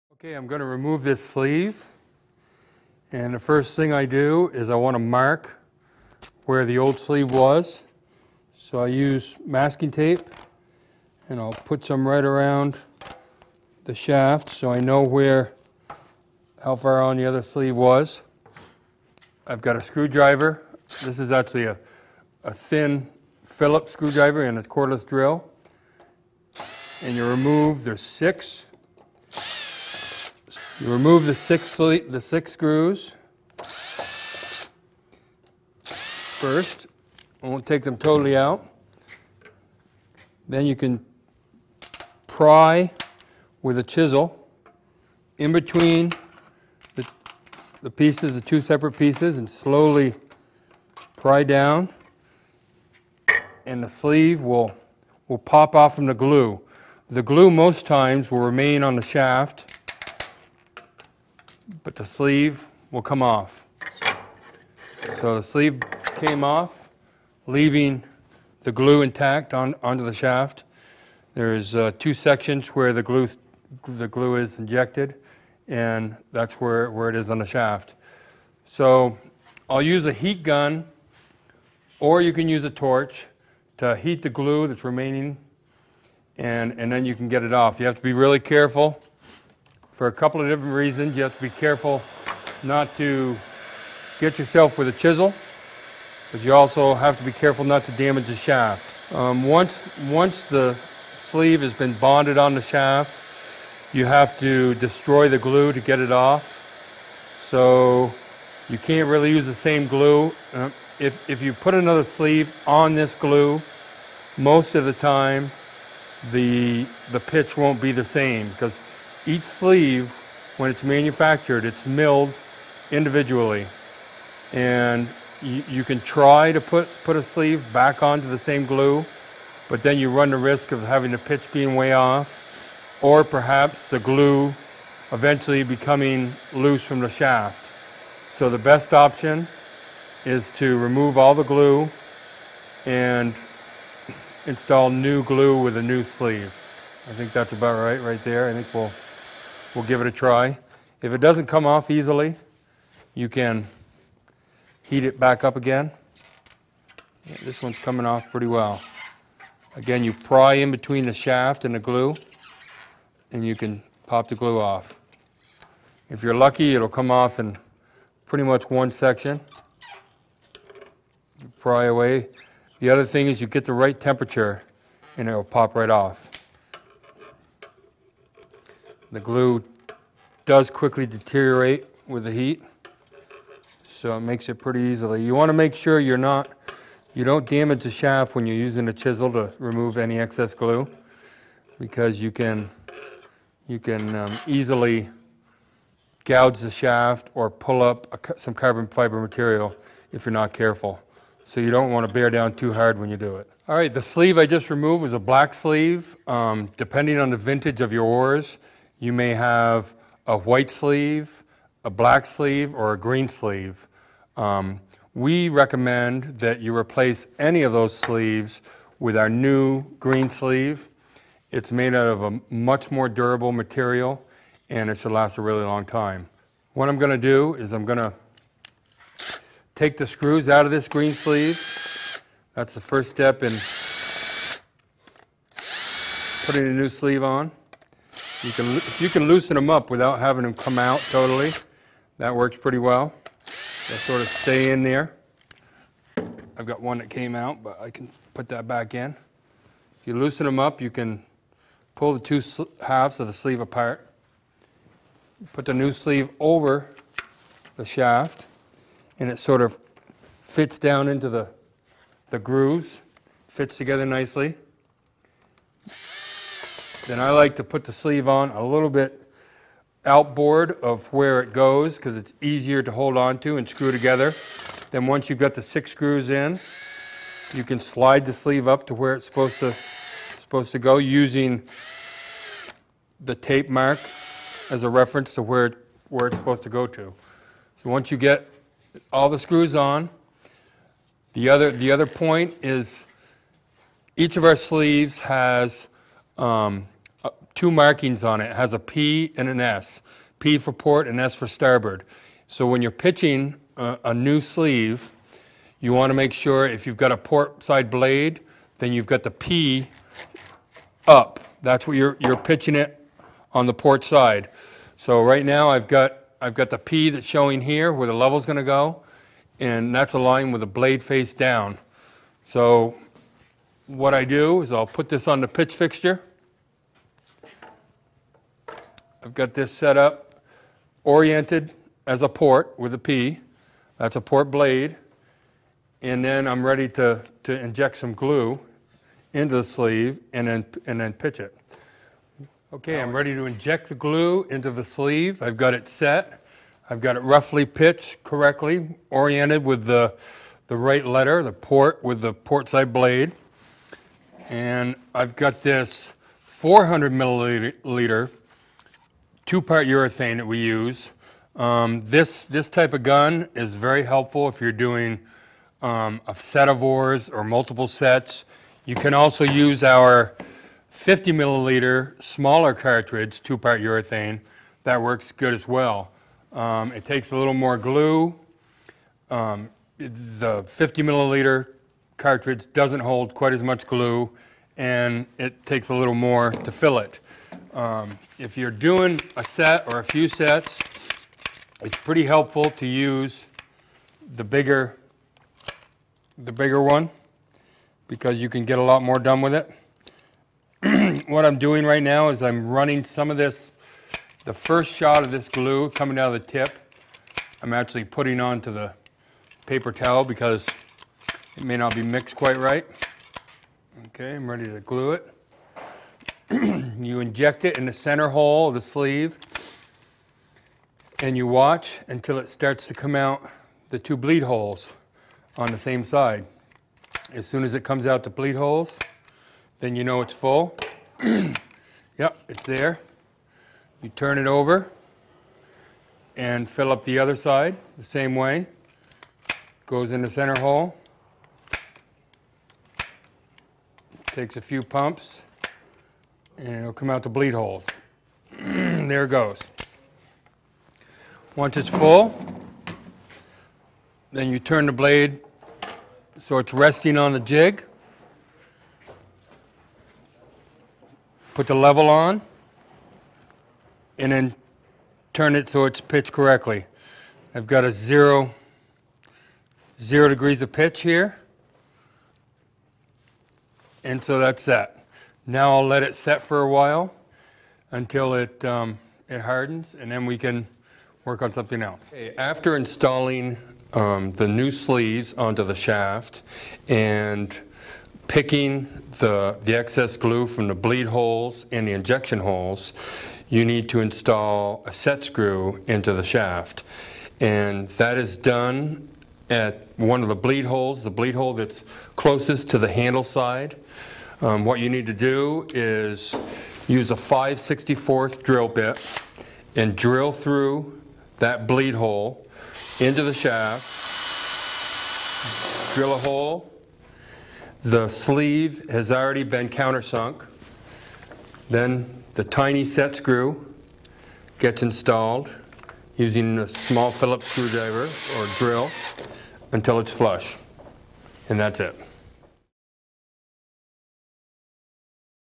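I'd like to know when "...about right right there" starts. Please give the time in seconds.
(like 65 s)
147 s.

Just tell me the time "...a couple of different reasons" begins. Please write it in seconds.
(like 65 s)
90 s.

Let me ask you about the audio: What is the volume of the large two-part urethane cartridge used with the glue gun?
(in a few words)
400 milliliters.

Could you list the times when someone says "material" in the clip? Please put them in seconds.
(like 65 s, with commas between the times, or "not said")
199 s, 223 s.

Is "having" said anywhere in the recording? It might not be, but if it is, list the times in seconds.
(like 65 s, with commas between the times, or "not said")
130 s, 240 s.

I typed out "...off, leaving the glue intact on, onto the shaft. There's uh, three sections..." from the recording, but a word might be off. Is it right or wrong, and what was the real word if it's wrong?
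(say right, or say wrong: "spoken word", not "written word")
wrong: "two", not "three".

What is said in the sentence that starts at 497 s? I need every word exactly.
And that is done at one of the bleed holes, the bleed hole that's closest to the handle side.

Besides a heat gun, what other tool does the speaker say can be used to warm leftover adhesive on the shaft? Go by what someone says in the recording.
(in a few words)
torch.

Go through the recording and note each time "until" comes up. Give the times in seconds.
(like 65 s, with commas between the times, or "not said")
422 s, 477 s, 529 s.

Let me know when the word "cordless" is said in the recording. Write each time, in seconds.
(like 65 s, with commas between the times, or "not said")
24 s.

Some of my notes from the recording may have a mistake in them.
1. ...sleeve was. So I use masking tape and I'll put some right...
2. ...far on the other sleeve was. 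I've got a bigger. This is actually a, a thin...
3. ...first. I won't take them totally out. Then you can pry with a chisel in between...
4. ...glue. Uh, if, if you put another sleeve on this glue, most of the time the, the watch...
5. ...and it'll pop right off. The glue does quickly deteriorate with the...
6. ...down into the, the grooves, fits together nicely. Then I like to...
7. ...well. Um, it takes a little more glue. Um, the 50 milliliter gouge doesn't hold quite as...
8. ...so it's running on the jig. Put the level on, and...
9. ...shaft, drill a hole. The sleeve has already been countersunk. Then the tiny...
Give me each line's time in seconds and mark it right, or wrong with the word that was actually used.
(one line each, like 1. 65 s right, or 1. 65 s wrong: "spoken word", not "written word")
1. 6 s right
2. 16 s wrong: "screwdriver", not "bigger"
3. 35 s right
4. 109 s wrong: "pitch", not "watch"
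5. 175 s right
6. 260 s right
7. 375 s wrong: "cartridge", not "gouge"
8. 456 s wrong: "resting", not "running"
9. 513 s right.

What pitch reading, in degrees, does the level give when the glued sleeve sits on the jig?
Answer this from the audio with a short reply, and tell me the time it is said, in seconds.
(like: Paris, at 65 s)
0, at 469 s.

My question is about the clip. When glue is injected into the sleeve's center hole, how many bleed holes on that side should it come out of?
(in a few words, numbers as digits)
2.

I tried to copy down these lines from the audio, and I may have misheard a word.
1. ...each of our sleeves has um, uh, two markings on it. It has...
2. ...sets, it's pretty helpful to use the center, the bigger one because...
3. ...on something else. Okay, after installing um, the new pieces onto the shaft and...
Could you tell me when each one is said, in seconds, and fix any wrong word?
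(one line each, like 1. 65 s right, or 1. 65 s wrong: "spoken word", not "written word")
1. 294 s right
2. 390 s wrong: "bigger", not "center"
3. 481 s wrong: "sleeves", not "pieces".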